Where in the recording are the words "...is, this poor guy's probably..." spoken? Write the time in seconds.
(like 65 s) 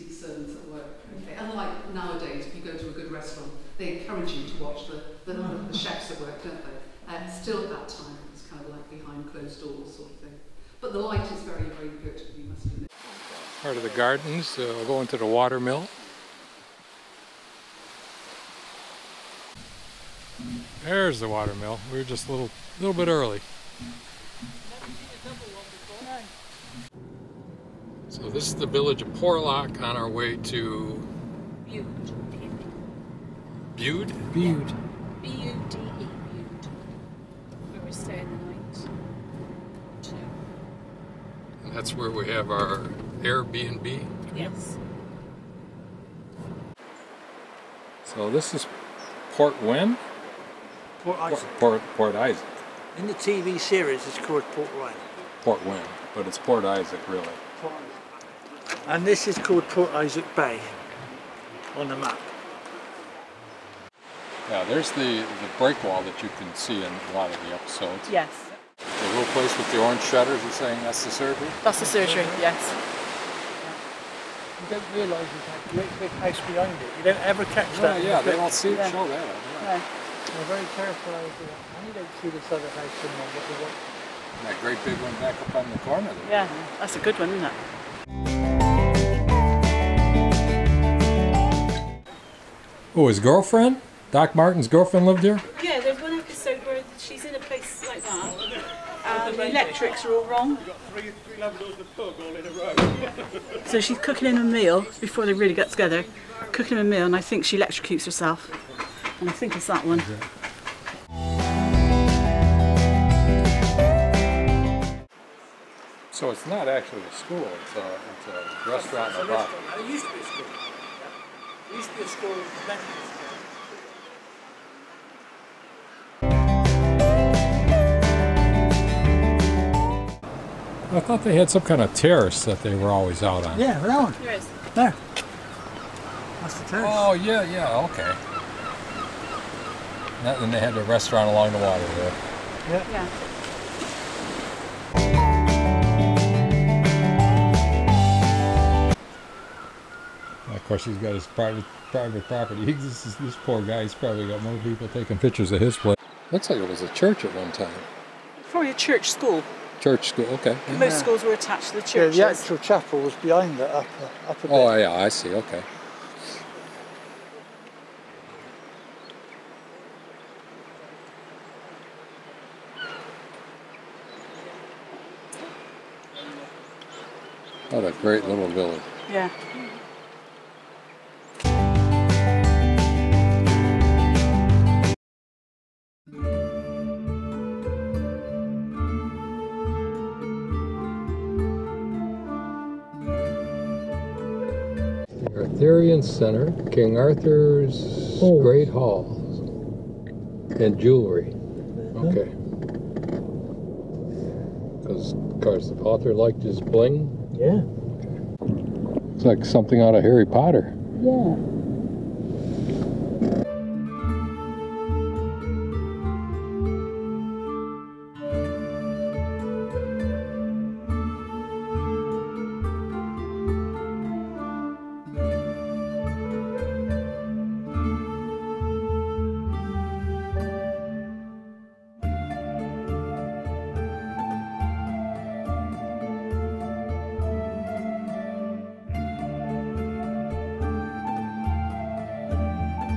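153 s.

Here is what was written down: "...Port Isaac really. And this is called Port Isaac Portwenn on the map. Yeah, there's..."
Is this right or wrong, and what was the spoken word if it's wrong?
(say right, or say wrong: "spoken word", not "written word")
wrong: "Bay", not "Portwenn".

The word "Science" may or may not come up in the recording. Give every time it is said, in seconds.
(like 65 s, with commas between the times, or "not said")
196 s.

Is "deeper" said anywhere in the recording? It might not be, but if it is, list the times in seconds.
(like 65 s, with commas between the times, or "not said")
not said.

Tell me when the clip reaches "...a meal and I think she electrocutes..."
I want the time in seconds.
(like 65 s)
106 s.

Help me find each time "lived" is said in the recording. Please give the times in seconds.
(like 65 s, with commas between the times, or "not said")
95 s.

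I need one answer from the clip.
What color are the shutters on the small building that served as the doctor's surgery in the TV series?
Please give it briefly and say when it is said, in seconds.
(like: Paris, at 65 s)
Orange, at 69 s.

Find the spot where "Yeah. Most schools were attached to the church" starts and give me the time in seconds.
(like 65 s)
160 s.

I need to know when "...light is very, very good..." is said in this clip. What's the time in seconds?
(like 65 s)
10 s.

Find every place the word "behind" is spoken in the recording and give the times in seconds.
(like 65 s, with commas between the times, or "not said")
76 s, 163 s.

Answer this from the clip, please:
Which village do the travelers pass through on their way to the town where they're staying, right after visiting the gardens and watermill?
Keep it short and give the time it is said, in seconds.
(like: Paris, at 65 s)
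Porlock, at 29 s.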